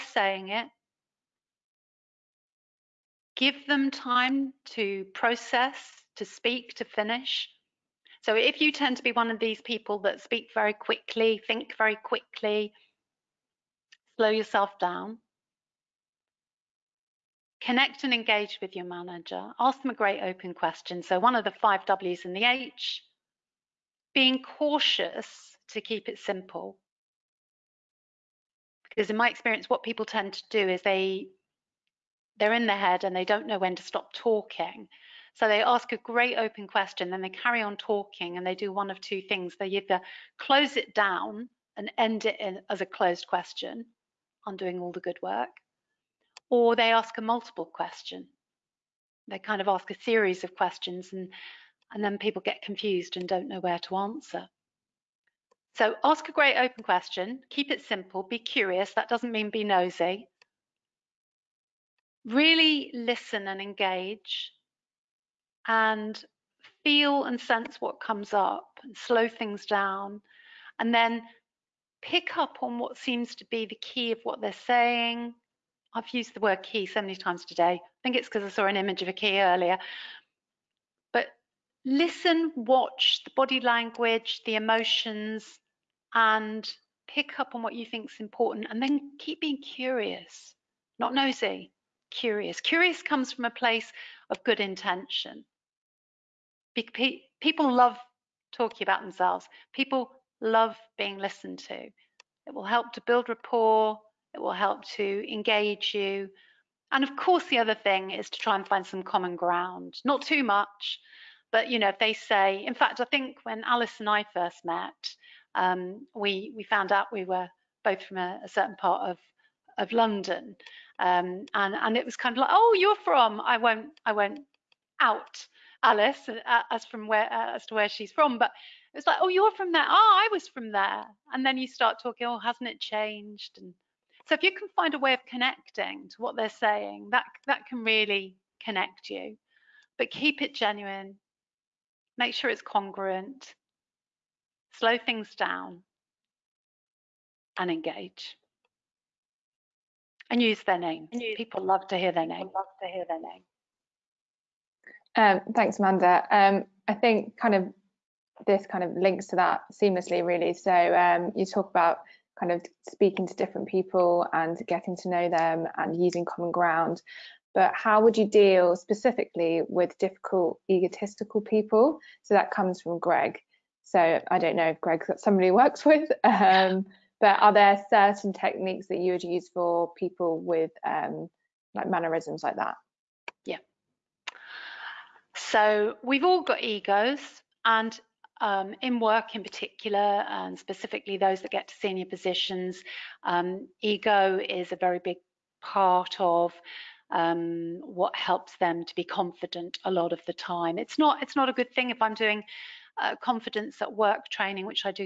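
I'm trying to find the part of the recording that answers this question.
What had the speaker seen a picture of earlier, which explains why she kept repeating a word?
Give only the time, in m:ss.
1:19.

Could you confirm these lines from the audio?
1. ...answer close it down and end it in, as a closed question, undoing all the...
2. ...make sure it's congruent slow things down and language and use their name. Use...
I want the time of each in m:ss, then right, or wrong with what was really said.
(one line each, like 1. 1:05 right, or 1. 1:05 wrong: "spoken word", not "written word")
1. 0:39 wrong: "either", not "answer"
2. 2:22 wrong: "engage", not "language".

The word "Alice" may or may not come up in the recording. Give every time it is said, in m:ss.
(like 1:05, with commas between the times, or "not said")
1:53, 2:05.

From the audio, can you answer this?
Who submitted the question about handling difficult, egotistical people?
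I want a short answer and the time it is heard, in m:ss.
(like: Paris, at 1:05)
Greg, at 2:52.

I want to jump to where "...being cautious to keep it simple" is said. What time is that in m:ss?
0:24.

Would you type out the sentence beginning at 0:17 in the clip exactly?
Connect and engage with your manager.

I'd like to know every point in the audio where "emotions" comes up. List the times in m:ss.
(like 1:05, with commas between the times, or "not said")
1:24.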